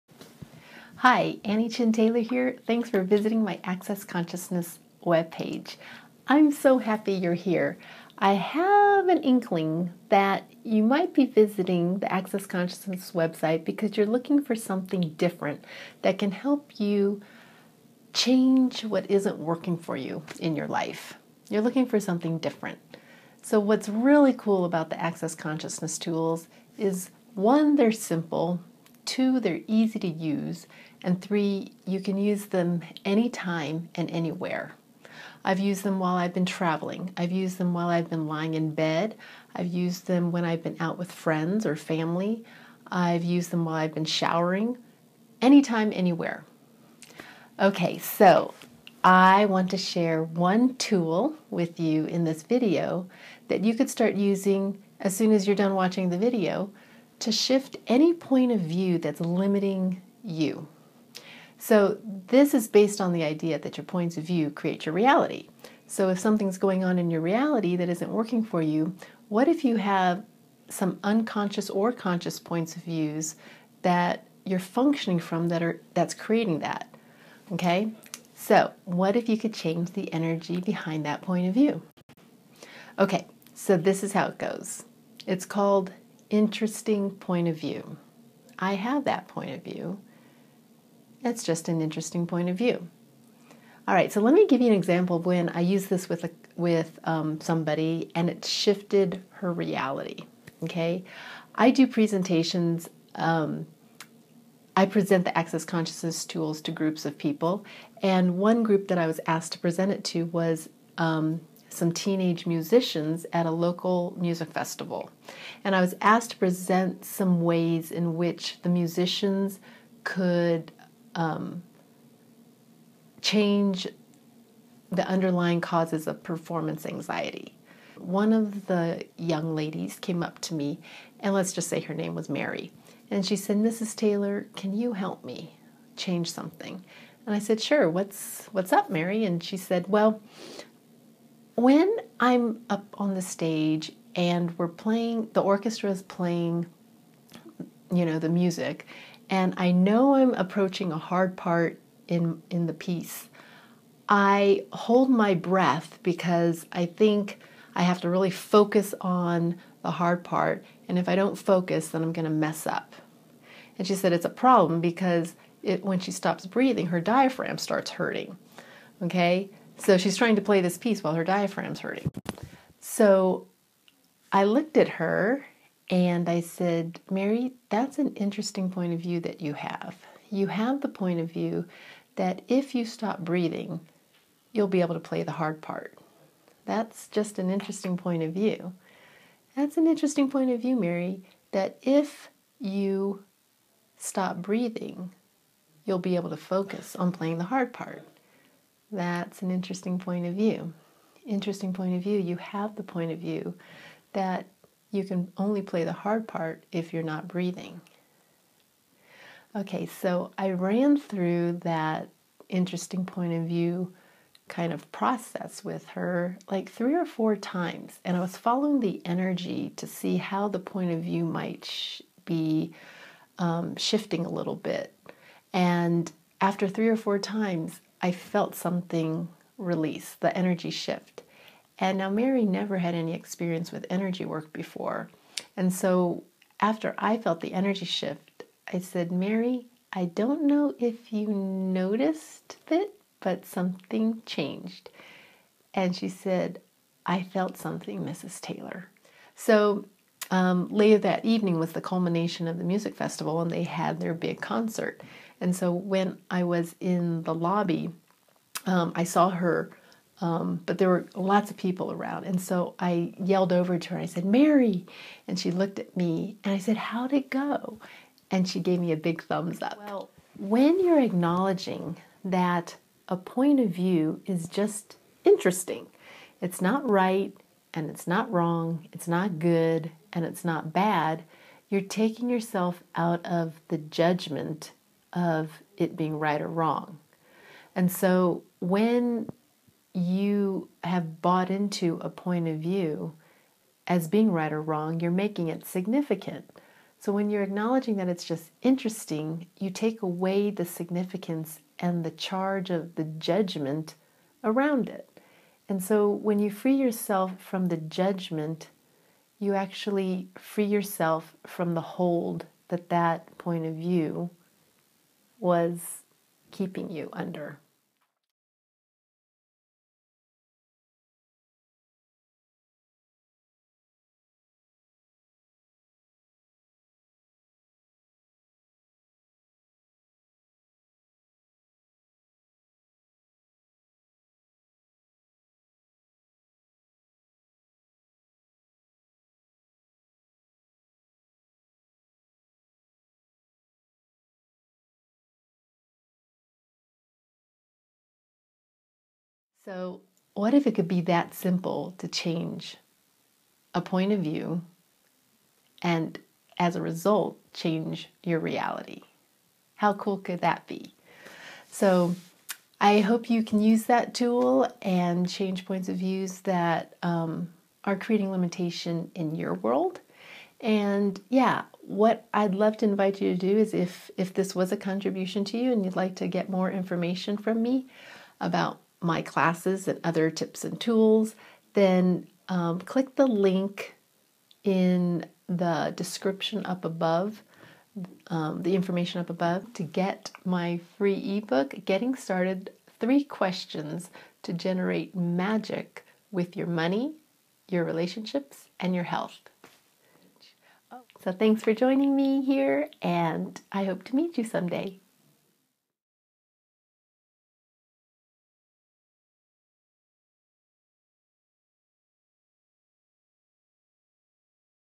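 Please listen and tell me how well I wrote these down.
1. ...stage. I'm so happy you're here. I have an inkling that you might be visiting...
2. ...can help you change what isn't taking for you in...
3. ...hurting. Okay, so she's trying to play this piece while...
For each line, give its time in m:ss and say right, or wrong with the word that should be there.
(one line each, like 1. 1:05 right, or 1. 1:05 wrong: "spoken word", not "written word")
1. 0:05 wrong: "webpage", not "stage"
2. 0:16 wrong: "working", not "taking"
3. 2:47 right.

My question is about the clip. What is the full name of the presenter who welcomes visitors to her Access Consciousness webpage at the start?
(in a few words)
Annie Chin Taylor.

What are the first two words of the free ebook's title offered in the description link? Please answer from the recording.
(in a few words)
Getting Started.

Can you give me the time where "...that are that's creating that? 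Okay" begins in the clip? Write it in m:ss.
1:15.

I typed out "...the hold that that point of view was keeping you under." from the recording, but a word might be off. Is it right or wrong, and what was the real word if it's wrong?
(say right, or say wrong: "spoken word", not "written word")
right.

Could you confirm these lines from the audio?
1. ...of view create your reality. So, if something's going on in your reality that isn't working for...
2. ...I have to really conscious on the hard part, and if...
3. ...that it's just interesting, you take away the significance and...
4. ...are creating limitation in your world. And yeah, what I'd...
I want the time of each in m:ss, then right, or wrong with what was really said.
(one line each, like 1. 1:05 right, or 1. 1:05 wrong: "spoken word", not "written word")
1. 1:04 right
2. 2:37 wrong: "focus", not "conscious"
3. 4:57 right
4. 6:07 right.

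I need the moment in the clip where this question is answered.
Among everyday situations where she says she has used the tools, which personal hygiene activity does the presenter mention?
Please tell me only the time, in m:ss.
0:44.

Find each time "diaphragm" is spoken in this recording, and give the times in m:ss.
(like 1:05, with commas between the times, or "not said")
2:46, 2:51.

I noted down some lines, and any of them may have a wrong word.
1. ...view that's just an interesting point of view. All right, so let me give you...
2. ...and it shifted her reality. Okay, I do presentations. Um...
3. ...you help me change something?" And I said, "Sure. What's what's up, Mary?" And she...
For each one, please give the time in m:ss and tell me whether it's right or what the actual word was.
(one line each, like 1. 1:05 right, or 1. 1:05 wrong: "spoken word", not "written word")
1. 1:29 right
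2. 1:38 right
3. 2:14 right.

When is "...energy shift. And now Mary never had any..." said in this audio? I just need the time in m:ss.
3:50.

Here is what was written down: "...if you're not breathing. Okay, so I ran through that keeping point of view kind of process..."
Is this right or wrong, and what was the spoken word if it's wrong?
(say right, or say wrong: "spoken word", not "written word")
wrong: "interesting", not "keeping".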